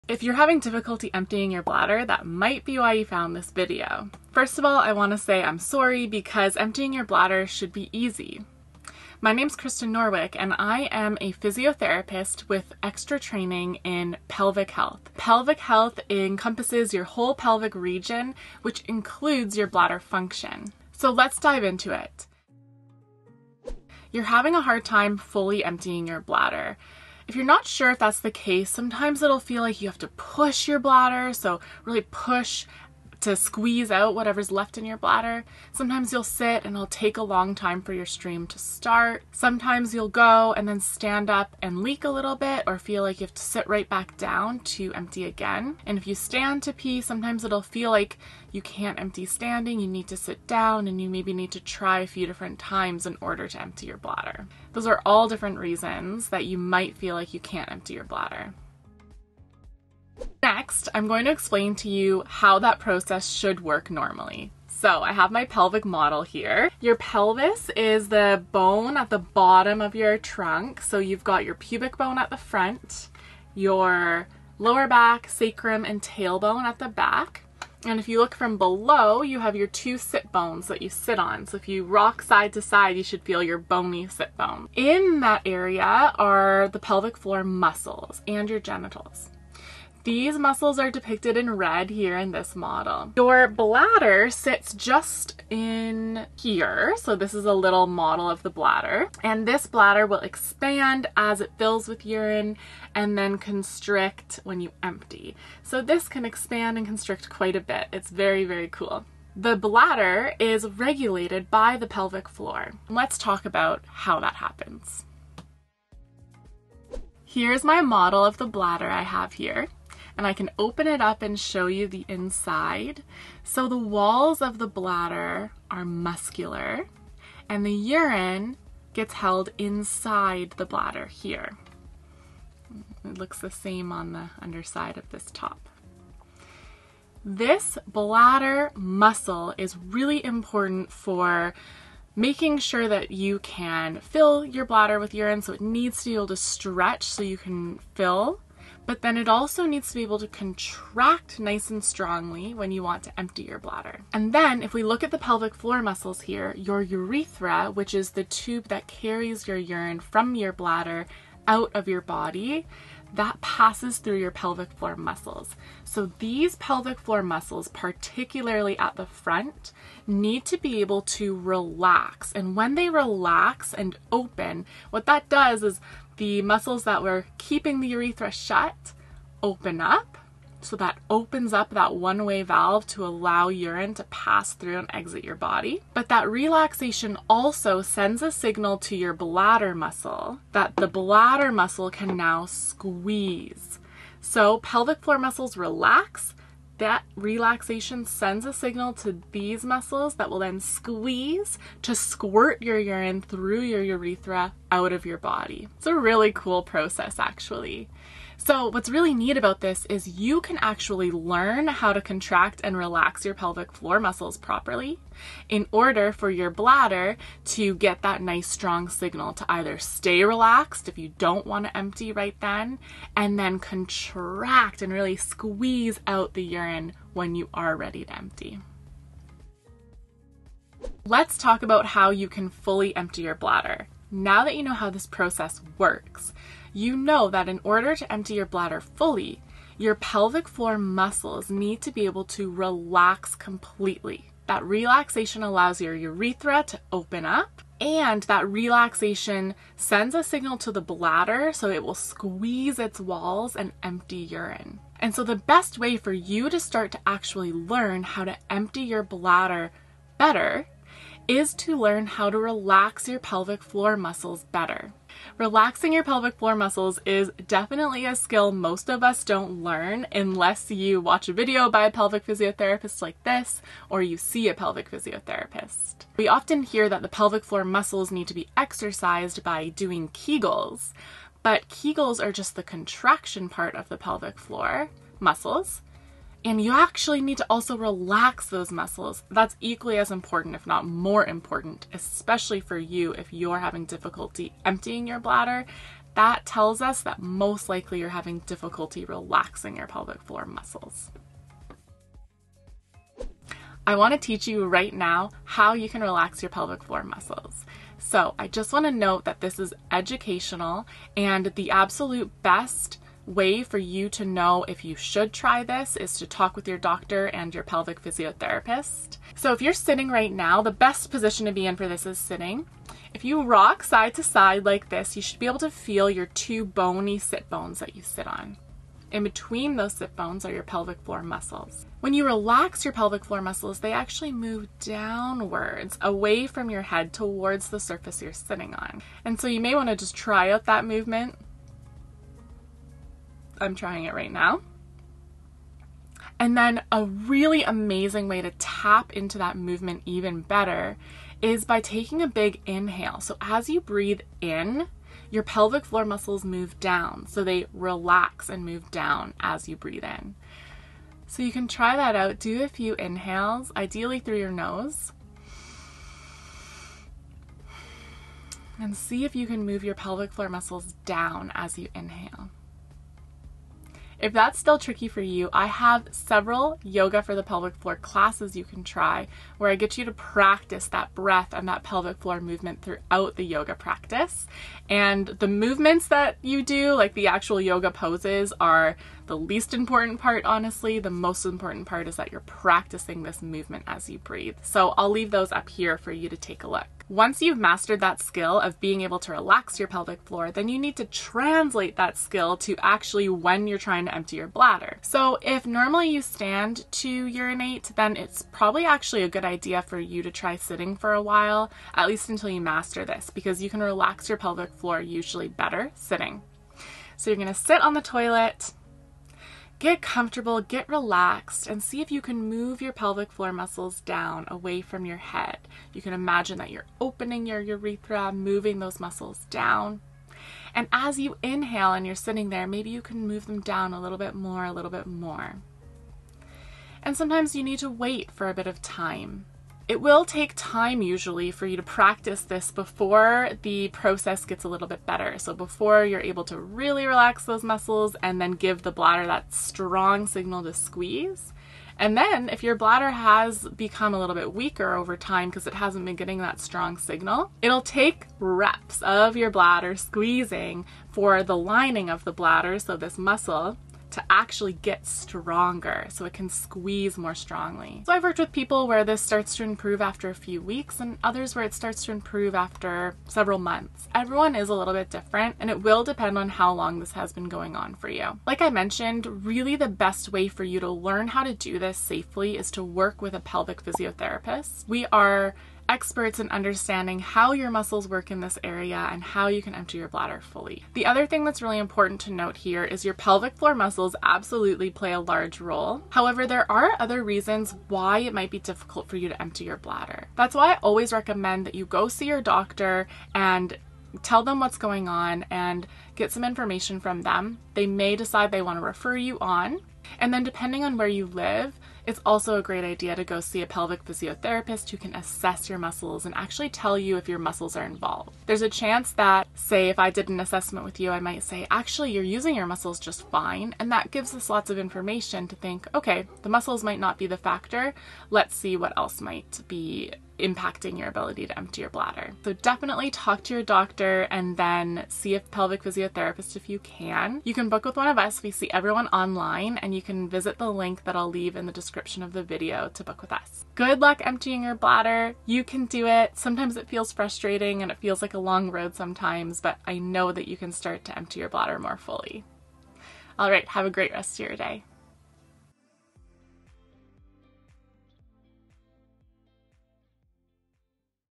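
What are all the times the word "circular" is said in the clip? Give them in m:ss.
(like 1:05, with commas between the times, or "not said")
not said.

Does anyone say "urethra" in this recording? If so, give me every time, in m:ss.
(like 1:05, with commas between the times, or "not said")
2:36, 2:57, 3:23, 4:05, 7:07.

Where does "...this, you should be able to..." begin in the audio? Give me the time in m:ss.
5:24.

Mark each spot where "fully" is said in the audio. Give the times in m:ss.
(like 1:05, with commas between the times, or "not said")
0:25, 3:52, 3:58, 8:10, 9:11.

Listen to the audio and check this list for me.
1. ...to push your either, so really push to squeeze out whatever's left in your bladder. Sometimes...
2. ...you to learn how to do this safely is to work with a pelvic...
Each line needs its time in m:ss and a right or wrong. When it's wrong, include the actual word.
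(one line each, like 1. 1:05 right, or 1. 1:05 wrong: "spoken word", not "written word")
1. 0:29 wrong: "bladder", not "either"
2. 8:00 right.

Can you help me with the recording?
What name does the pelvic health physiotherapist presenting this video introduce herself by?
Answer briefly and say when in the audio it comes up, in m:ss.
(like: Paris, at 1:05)
Krysta Norwick, at 0:09.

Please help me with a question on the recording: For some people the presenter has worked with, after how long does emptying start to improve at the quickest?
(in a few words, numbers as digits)
a few weeks.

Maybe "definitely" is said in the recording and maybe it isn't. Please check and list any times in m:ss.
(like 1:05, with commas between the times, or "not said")
4:27, 8:52.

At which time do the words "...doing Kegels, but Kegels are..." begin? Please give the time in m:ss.
4:39.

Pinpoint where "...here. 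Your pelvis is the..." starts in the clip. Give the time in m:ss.
1:06.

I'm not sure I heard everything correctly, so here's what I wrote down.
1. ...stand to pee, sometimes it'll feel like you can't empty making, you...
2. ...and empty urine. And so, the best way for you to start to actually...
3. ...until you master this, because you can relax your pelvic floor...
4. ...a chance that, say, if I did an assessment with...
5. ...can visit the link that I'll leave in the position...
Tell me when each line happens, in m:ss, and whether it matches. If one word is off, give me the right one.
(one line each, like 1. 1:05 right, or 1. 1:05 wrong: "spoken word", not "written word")
1. 0:46 wrong: "standing", not "making"
2. 4:13 right
3. 6:52 right
4. 8:38 right
5. 9:00 wrong: "description", not "position".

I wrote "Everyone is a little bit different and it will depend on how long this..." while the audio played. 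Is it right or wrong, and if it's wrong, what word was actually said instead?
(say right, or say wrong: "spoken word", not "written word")
right.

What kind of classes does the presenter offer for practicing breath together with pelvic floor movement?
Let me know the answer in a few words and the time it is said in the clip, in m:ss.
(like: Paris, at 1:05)
yoga for the pelvic floor, at 6:16.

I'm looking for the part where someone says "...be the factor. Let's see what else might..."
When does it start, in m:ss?
8:47.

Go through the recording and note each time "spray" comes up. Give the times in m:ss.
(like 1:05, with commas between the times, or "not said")
not said.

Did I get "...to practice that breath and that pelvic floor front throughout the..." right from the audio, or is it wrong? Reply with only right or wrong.
wrong.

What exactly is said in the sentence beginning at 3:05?
But that relaxation also sends a signal to your bladder muscle that the bladder muscle can now squeeze.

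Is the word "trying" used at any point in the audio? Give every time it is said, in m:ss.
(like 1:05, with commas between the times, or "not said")
5:43, 6:43.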